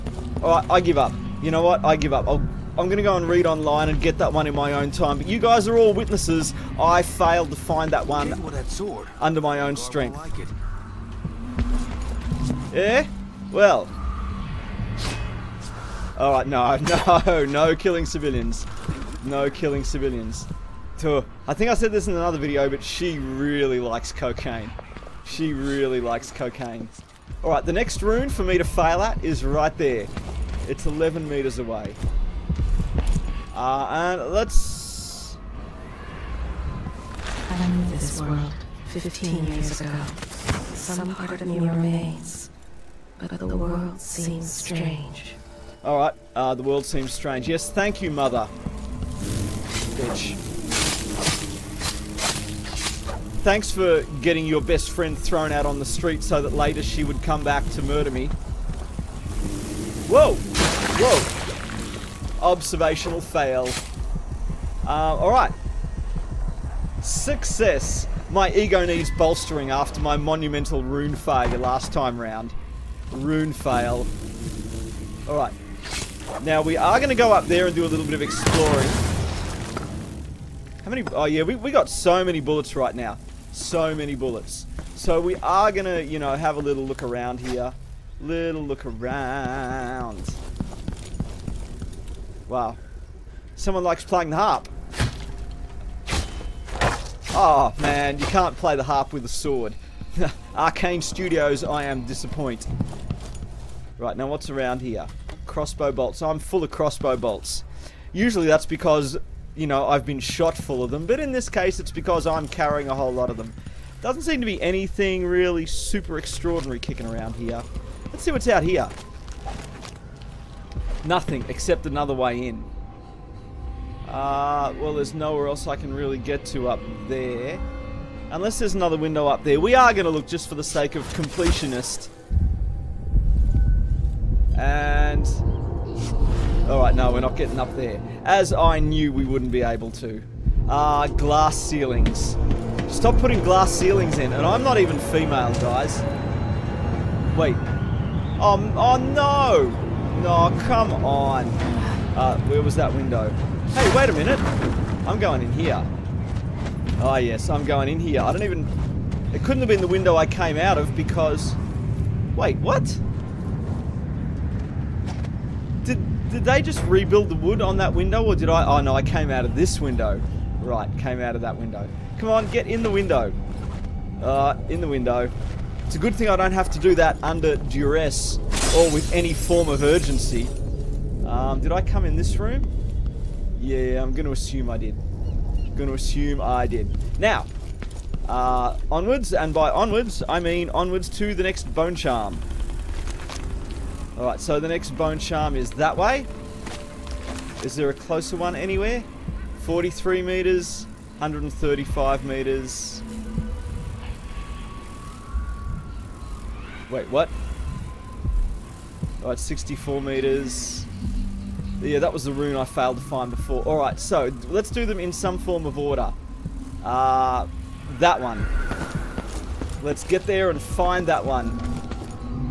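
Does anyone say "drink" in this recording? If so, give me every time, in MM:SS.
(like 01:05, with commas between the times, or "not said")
not said.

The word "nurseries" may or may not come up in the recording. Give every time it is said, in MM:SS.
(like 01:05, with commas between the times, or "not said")
not said.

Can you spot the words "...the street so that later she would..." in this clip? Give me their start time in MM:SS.
00:55.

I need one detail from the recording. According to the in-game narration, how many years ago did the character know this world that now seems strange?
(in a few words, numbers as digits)
15 years.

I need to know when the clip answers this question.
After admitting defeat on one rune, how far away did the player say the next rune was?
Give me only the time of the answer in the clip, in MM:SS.
00:30.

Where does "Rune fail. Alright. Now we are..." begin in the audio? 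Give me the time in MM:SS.
01:13.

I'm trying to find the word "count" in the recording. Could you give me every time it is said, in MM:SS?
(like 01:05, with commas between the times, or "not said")
not said.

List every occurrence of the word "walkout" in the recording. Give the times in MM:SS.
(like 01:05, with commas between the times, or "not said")
not said.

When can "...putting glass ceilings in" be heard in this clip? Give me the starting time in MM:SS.
02:23.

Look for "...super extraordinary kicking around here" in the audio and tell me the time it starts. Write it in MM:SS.
01:55.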